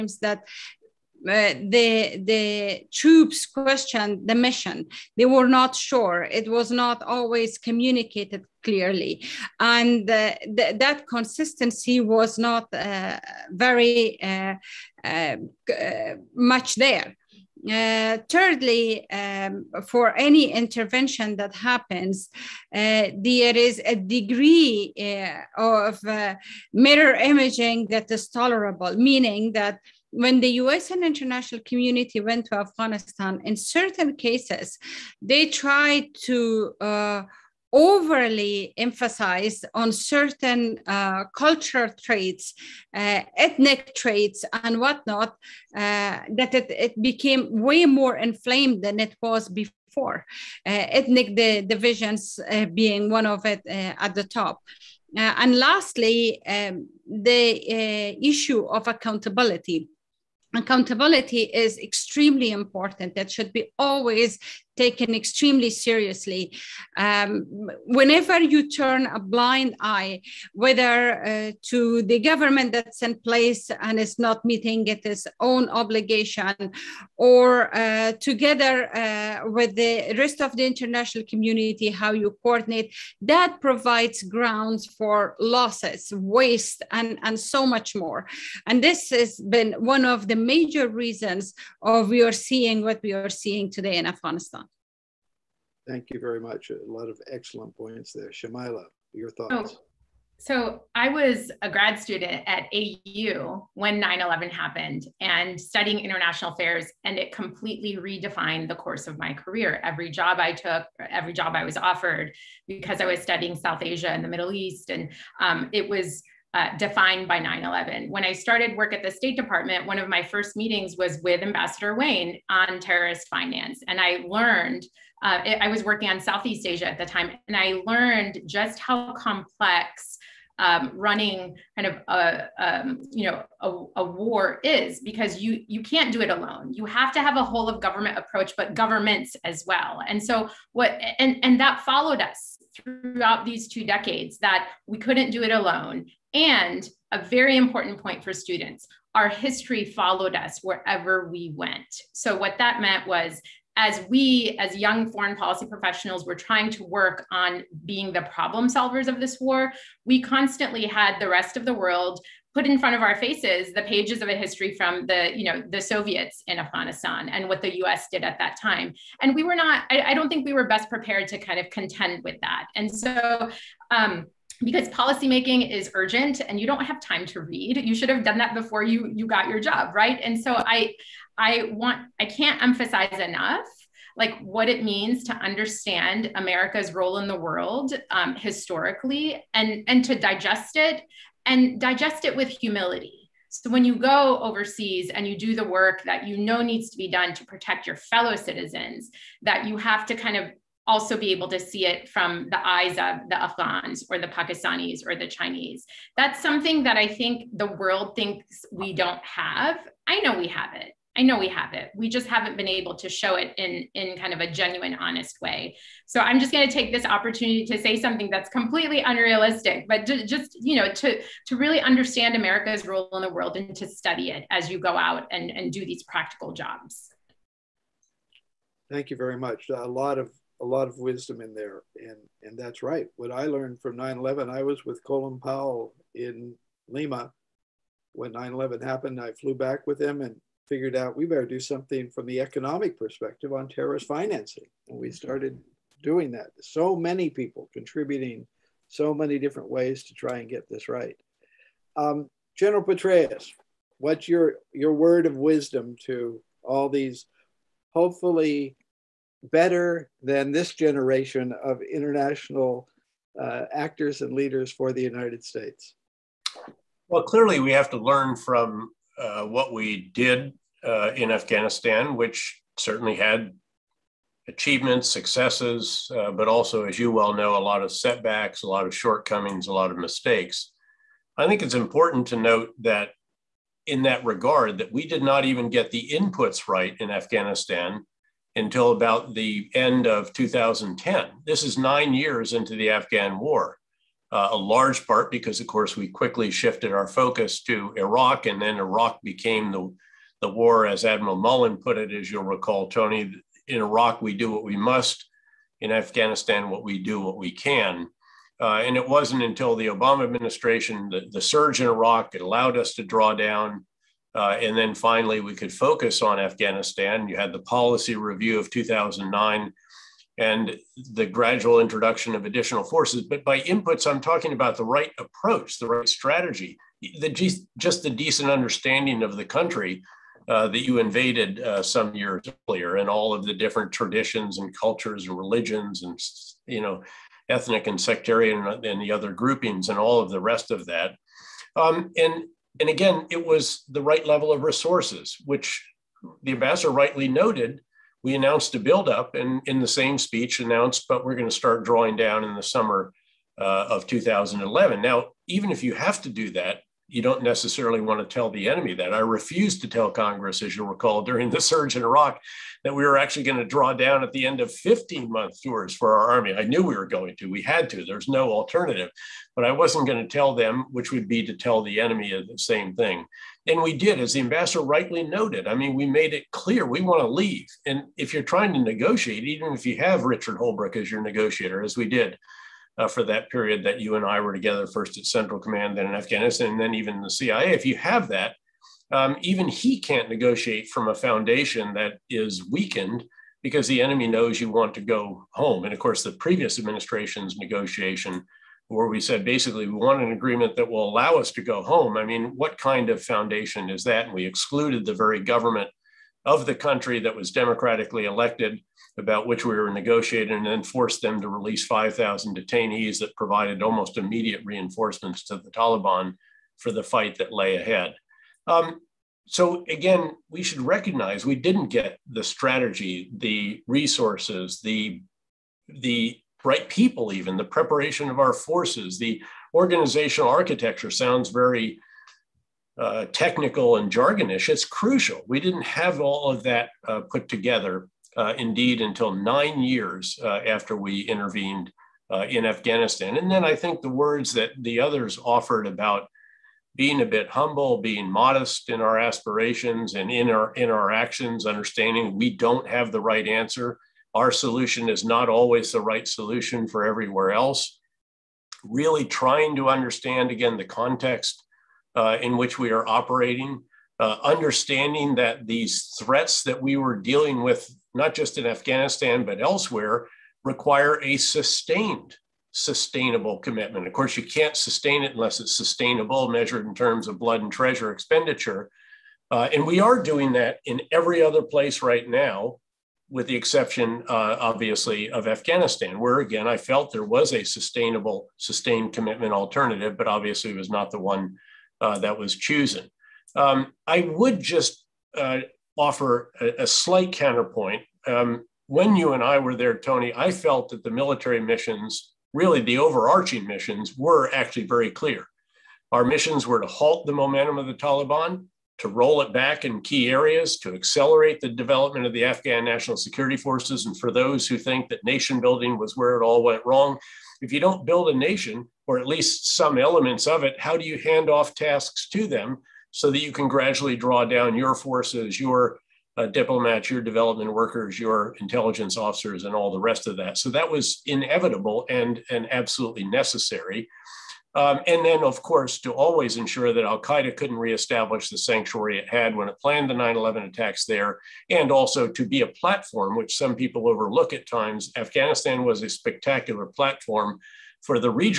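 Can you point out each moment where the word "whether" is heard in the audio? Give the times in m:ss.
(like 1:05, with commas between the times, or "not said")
1:10.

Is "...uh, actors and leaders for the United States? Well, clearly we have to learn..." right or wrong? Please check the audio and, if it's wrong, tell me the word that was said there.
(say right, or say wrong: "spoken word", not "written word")
right.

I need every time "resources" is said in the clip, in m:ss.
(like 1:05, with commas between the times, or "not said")
5:44, 7:03.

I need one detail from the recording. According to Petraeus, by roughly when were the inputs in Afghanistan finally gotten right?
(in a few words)
end of 2010.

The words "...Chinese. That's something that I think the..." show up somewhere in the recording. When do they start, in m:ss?
3:25.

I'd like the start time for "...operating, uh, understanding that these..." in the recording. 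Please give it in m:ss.
7:43.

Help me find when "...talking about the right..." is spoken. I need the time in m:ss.
5:24.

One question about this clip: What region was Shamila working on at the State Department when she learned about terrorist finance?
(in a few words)
Southeast Asia.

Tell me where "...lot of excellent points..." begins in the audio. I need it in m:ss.
1:36.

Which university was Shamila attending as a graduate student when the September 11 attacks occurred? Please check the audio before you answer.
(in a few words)
AU.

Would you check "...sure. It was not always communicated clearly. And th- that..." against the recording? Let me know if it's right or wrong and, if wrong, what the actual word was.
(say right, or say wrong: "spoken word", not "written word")
right.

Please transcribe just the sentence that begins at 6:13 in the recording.
And we did, as the ambassador rightly noted.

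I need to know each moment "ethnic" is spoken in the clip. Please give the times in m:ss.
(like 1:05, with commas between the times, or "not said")
0:43, 0:50, 5:37.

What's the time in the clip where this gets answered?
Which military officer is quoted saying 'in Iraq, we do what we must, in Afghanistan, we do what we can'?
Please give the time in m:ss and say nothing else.
5:01.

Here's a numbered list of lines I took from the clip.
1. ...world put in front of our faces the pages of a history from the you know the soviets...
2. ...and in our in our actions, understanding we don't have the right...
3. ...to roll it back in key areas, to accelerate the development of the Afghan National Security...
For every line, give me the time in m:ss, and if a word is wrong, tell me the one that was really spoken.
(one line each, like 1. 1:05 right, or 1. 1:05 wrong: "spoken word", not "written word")
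1. 2:41 right
2. 7:30 right
3. 8:28 right.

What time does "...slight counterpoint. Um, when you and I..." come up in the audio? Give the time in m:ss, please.
8:16.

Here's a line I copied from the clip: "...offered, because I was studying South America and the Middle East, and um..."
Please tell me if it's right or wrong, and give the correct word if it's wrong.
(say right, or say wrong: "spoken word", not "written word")
wrong: "Asia", not "America".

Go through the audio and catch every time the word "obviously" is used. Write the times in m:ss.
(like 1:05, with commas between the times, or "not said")
8:04, 8:10.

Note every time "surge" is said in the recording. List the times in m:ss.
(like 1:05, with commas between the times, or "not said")
5:11, 6:01.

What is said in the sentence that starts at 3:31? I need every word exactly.
We just haven't been able to show it in in kind of a genuine, honest way.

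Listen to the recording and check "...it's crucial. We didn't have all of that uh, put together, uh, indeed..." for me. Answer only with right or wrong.
right.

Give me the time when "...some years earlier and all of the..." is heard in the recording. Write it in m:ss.
5:31.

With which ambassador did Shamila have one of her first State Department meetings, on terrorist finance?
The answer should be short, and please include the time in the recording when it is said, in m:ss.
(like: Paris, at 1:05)
Ambassador Wayne, at 2:01.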